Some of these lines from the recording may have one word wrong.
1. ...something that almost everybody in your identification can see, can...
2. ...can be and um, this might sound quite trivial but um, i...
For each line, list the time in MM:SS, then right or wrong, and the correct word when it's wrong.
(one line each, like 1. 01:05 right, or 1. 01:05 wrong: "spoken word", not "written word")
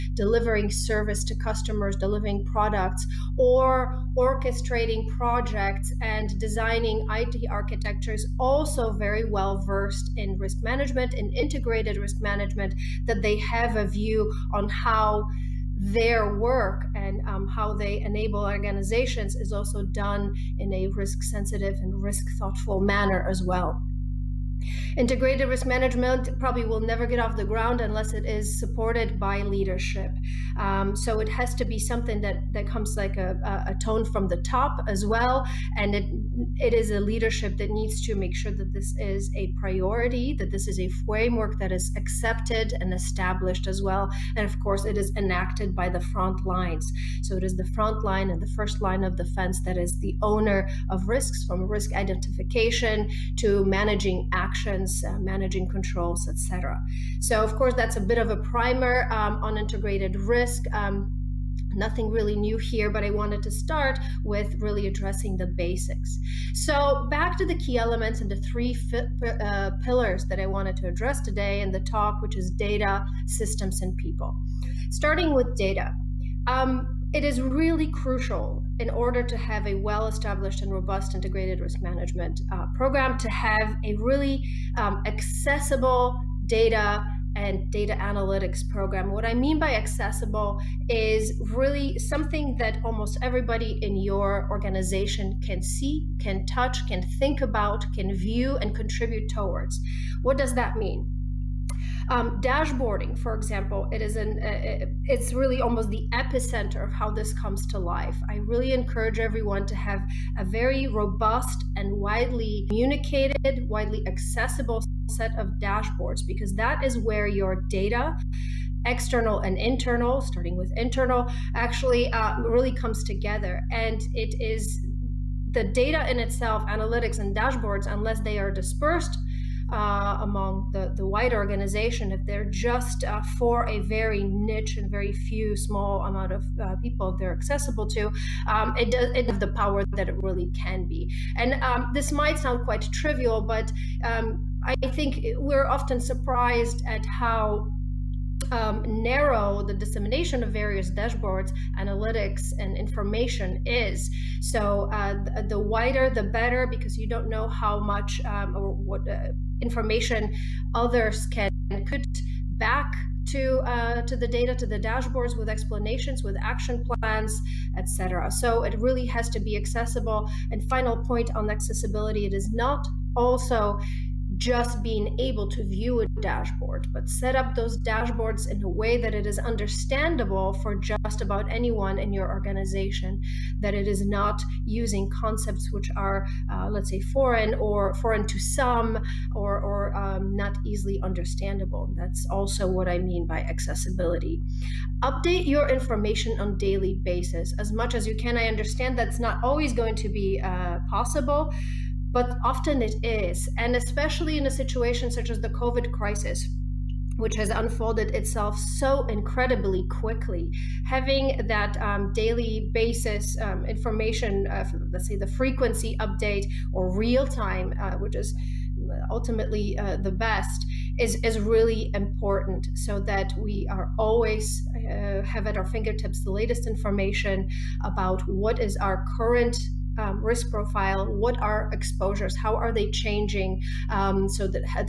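1. 01:31 wrong: "organization", not "identification"
2. 02:20 right.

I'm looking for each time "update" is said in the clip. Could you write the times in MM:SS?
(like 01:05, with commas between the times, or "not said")
03:15, 03:35.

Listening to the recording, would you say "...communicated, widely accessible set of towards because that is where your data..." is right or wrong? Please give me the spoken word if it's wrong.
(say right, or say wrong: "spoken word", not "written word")
wrong: "dashboards", not "towards".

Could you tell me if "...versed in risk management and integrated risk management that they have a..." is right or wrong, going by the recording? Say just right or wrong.
right.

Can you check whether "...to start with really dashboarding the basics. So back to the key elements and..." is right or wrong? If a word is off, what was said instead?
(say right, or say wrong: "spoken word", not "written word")
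wrong: "addressing", not "dashboarding".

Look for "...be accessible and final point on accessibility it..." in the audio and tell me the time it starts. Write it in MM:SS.
02:49.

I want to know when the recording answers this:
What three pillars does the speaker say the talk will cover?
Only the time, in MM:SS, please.
01:12.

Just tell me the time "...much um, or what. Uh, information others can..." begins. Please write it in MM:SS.
02:37.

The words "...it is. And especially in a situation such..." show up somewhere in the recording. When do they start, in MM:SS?
03:22.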